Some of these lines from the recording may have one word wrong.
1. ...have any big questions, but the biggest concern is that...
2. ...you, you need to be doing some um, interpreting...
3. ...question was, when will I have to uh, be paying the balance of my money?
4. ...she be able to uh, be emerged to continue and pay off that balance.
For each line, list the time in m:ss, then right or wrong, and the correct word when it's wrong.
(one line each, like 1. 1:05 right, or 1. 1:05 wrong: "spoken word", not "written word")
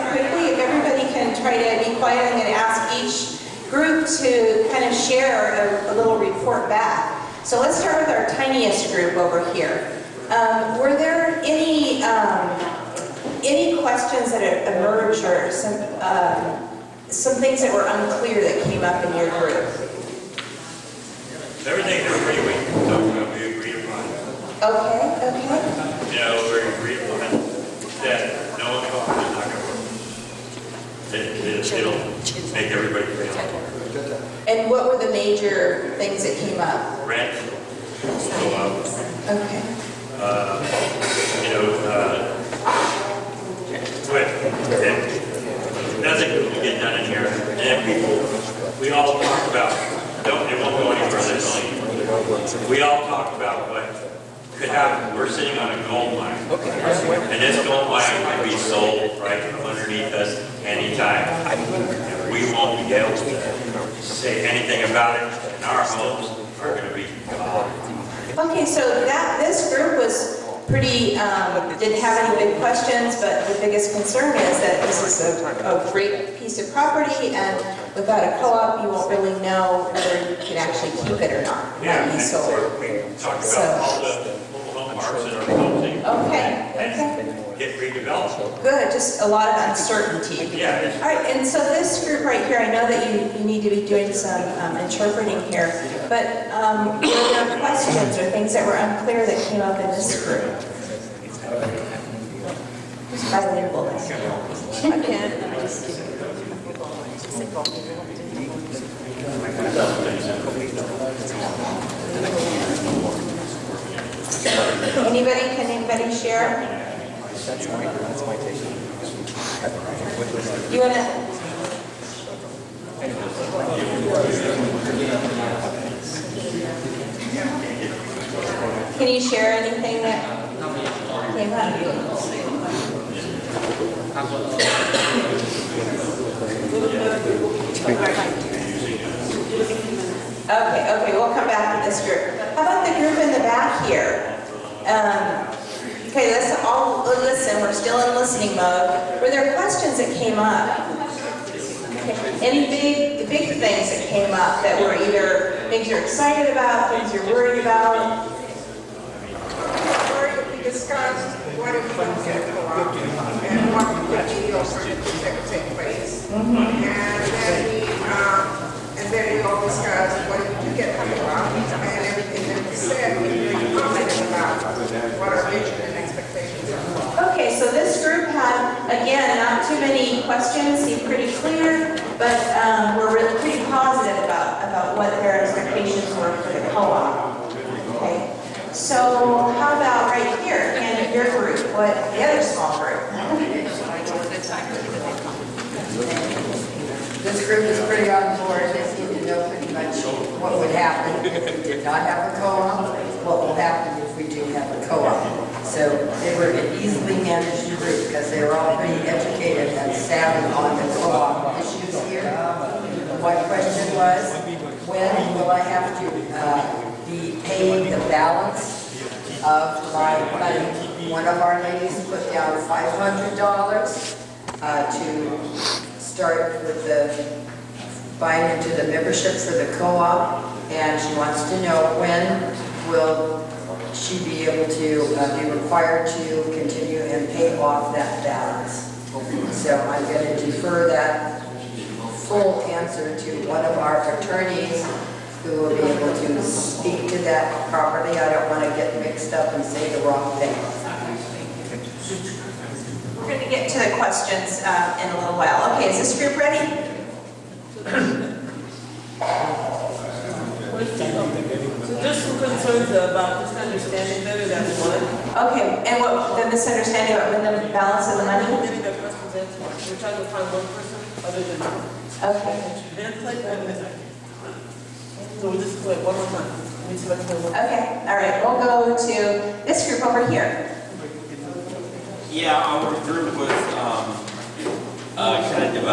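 1. 1:11 right
2. 1:33 right
3. 3:33 right
4. 3:54 wrong: "required", not "emerged".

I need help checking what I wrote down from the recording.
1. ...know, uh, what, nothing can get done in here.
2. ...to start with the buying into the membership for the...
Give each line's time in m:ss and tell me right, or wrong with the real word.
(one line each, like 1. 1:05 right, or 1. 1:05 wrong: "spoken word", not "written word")
1. 0:41 right
2. 3:44 right.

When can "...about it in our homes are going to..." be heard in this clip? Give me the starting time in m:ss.
1:04.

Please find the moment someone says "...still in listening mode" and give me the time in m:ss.
2:27.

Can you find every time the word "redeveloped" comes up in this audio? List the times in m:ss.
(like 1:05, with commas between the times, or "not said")
1:27.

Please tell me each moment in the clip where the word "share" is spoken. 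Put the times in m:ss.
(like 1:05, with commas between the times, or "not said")
1:56, 2:09.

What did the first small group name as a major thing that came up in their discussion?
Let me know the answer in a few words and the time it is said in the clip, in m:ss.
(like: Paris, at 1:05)
Rent, at 0:37.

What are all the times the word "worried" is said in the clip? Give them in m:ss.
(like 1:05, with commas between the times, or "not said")
2:37.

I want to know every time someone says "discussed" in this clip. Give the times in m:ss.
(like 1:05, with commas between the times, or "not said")
2:40, 2:49.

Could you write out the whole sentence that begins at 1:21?
Yeah, and so we talked about so.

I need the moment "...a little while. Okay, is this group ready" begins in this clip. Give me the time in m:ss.
4:15.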